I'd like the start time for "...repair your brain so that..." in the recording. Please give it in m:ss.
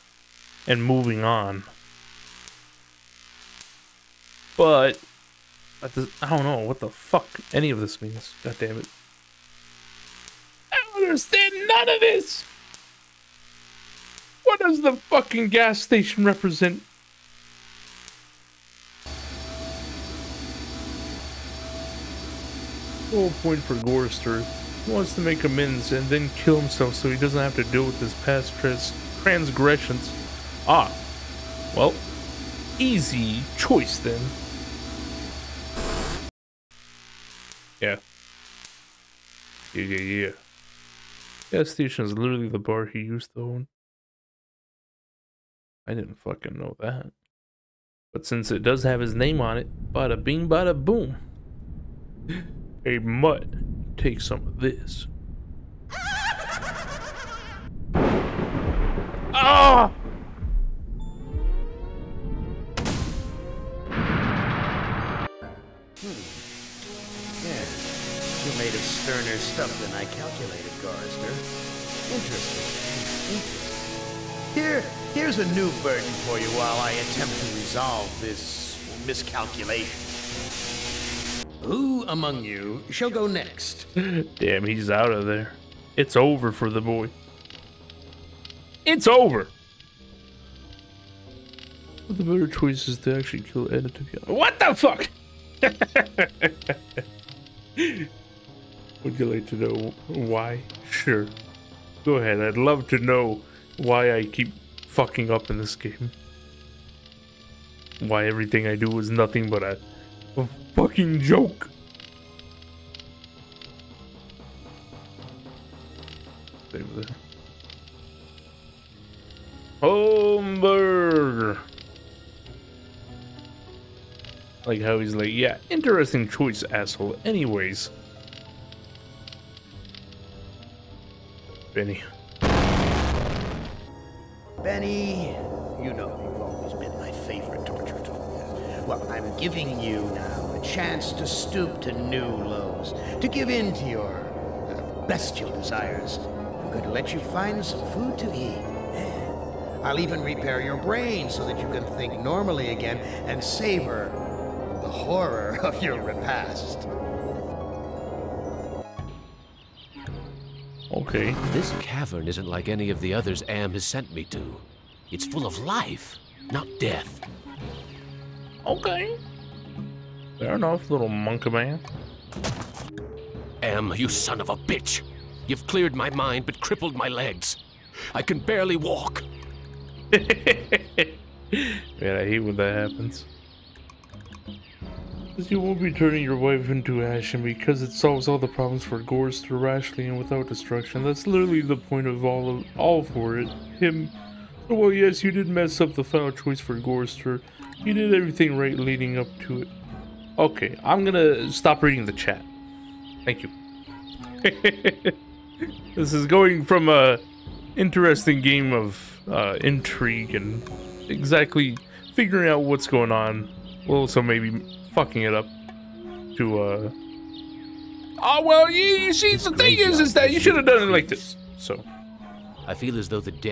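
2:30.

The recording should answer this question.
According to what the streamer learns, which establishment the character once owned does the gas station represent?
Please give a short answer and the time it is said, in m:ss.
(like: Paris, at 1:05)
The bar, at 0:42.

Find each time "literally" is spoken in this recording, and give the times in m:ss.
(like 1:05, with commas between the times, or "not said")
0:42, 3:11.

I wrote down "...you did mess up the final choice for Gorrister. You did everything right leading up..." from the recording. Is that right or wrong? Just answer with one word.
right.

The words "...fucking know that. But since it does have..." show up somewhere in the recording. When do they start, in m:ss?
0:46.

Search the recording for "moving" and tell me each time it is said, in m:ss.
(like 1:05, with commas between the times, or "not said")
0:00.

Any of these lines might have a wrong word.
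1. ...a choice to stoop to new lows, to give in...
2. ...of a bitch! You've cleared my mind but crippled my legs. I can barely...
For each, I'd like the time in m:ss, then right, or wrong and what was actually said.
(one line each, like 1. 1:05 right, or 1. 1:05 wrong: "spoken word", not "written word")
1. 2:20 wrong: "chance", not "choice"
2. 2:54 right.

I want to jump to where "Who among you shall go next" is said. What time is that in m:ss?
1:21.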